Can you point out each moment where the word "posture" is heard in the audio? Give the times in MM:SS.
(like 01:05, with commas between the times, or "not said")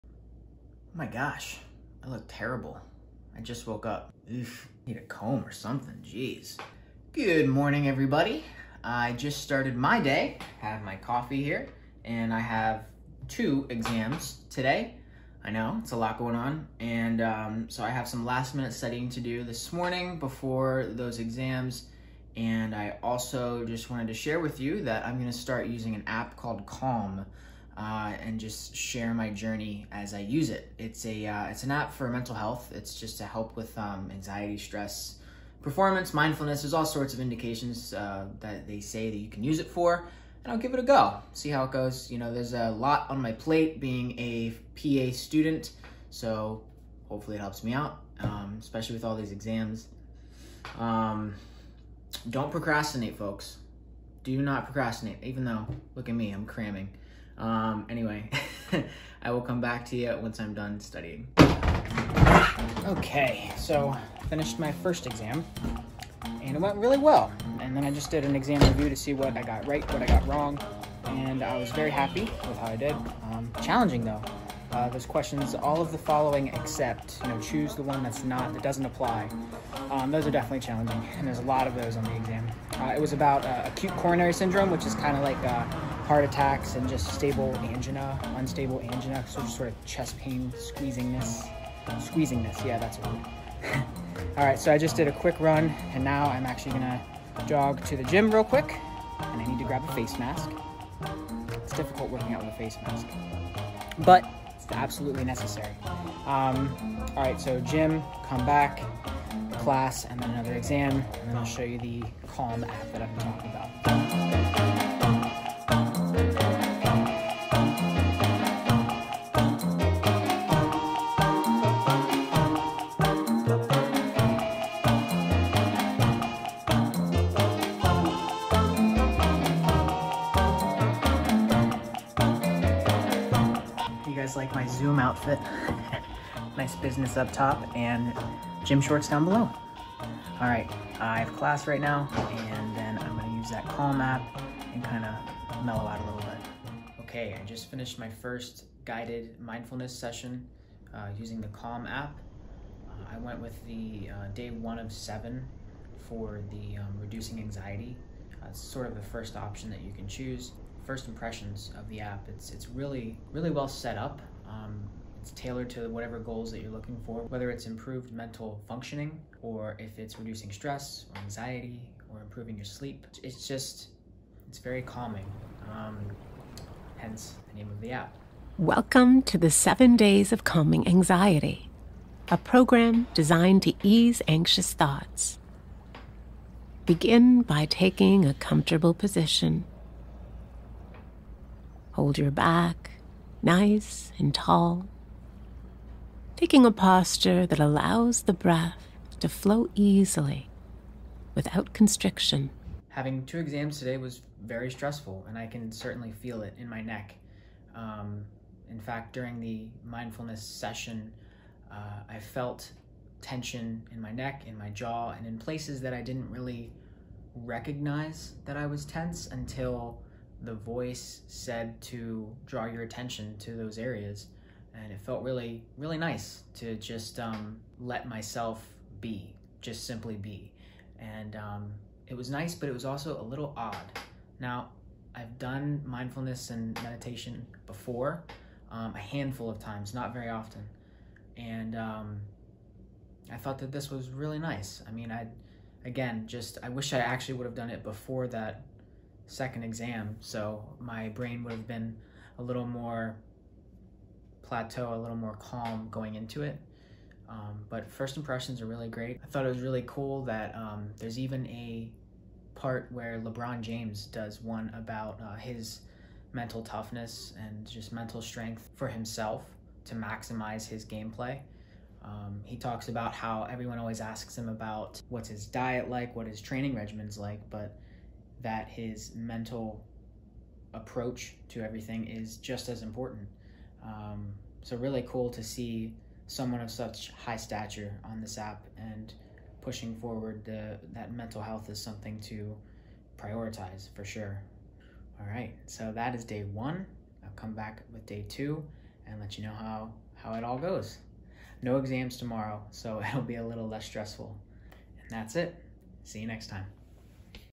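03:16.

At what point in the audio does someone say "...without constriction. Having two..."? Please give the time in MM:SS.
03:21.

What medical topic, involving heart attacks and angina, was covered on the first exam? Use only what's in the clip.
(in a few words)
Acute coronary syndrome.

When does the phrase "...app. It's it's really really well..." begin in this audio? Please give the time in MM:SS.
02:41.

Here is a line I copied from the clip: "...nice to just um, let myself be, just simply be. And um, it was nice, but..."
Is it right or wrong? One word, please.
right.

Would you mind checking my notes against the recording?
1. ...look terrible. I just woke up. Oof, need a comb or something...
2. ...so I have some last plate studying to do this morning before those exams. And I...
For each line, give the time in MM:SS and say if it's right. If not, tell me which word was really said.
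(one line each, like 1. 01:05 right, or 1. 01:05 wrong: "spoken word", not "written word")
1. 00:02 right
2. 00:17 wrong: "minute", not "plate".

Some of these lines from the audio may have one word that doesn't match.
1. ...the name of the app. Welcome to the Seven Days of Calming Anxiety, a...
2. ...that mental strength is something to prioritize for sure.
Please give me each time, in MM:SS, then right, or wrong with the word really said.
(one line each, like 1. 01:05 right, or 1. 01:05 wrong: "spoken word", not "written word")
1. 02:57 right
2. 04:50 wrong: "health", not "strength".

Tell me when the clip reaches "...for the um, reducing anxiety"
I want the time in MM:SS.
02:36.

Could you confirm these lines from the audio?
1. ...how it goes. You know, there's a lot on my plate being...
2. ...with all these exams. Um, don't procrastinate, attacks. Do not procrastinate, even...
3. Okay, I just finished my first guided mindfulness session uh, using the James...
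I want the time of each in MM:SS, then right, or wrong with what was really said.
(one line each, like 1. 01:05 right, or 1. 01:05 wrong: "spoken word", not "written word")
1. 00:41 right
2. 00:48 wrong: "folks", not "attacks"
3. 02:27 wrong: "Calm", not "James".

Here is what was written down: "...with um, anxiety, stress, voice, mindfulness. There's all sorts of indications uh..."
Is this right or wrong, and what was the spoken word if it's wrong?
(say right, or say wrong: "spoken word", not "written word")
wrong: "performance", not "voice".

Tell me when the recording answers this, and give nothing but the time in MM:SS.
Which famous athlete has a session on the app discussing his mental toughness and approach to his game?
04:23.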